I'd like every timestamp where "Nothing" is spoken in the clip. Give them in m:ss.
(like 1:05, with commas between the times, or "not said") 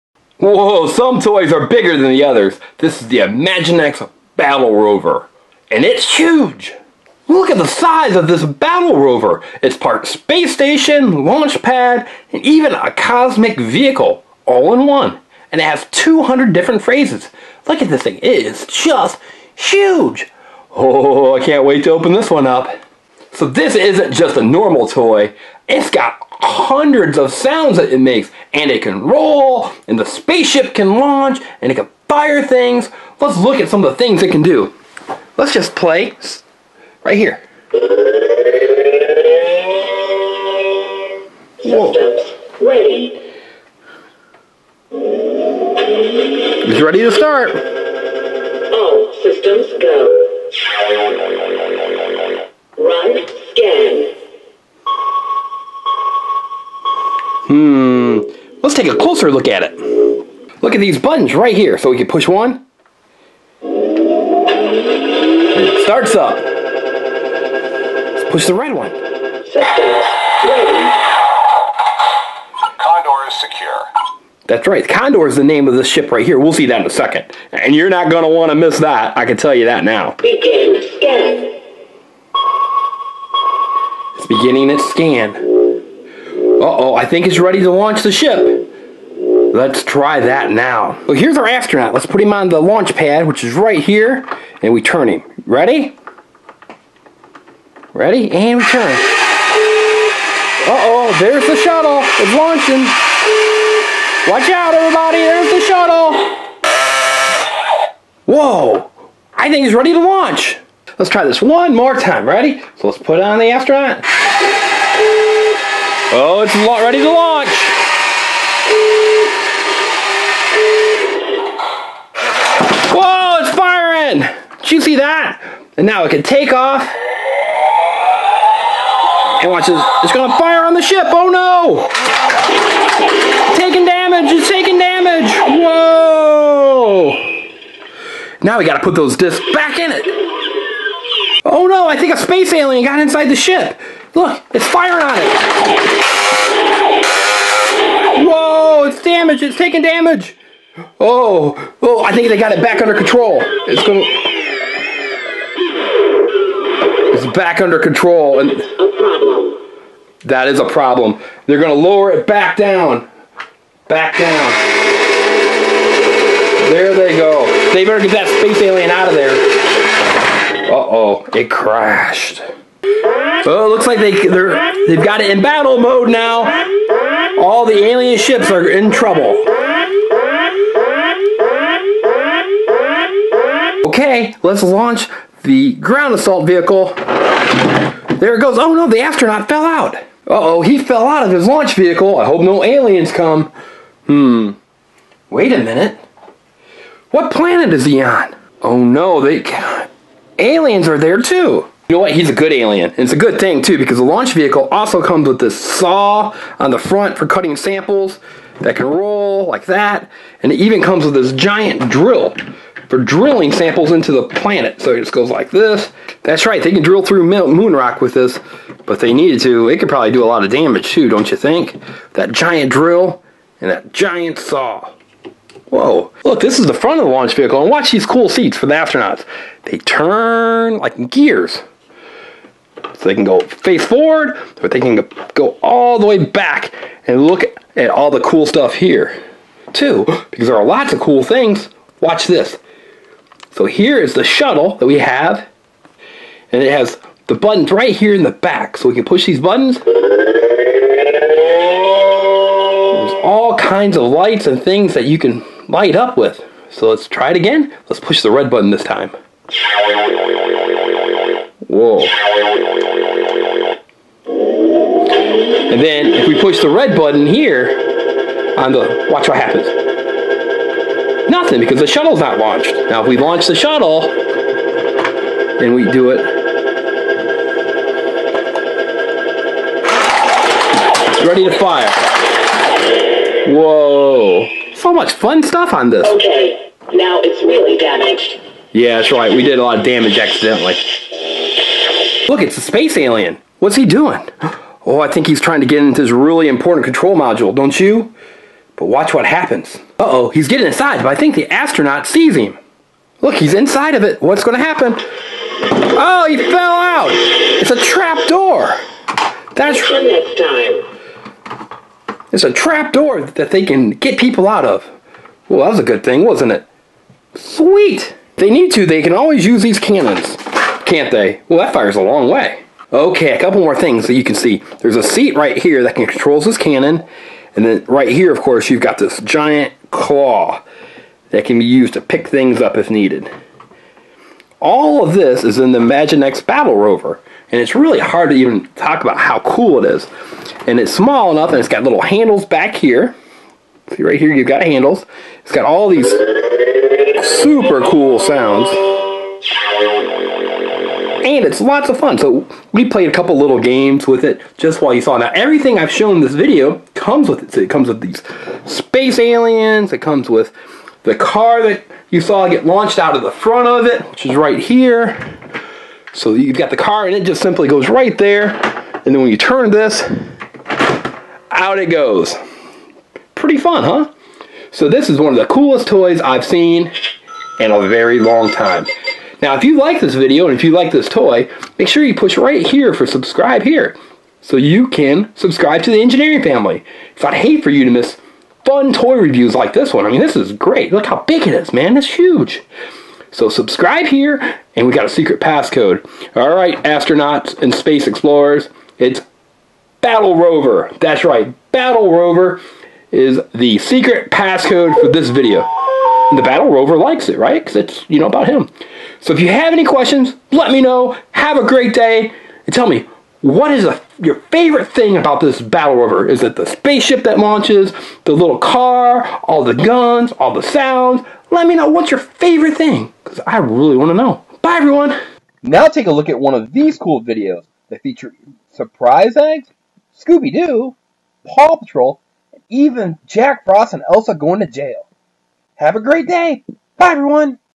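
4:31.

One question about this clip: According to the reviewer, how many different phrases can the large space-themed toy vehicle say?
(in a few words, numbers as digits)
200.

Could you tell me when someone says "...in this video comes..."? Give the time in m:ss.
5:56.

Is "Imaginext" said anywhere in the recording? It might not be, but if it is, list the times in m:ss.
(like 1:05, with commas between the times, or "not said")
0:03, 5:35.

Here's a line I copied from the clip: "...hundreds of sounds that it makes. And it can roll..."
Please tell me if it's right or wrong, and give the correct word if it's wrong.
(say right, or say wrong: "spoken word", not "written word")
right.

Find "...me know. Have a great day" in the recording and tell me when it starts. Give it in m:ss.
6:50.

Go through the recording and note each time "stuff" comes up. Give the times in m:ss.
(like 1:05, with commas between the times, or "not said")
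3:58, 4:45.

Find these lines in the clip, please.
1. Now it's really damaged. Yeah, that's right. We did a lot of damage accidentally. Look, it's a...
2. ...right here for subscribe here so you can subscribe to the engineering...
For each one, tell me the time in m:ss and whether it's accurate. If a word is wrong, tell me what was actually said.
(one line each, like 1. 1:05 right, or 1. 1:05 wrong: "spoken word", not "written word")
1. 4:46 right
2. 6:22 right.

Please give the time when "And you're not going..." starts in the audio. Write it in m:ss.
1:17.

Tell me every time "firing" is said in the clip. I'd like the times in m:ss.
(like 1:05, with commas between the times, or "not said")
2:03, 2:24.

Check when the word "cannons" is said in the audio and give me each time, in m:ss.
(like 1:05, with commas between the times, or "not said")
5:19, 5:26.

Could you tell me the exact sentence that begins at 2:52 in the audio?
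Oh, it looks like they, they're, they've got it in battle mode now.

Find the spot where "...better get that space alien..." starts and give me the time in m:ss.
2:47.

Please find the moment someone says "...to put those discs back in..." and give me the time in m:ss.
2:18.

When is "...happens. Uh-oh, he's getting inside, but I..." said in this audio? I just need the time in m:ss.
4:59.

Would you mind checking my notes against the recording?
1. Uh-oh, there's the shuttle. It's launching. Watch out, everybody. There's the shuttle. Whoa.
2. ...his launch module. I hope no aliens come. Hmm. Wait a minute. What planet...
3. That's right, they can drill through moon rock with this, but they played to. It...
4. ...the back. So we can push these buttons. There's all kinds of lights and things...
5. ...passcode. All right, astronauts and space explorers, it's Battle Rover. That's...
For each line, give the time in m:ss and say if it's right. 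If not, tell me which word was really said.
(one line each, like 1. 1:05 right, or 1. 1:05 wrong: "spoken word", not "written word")
1. 1:40 right
2. 3:11 wrong: "vehicle", not "module"
3. 3:36 wrong: "needed", not "played"
4. 4:08 right
5. 6:35 right.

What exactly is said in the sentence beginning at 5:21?
Well, that fires a long way.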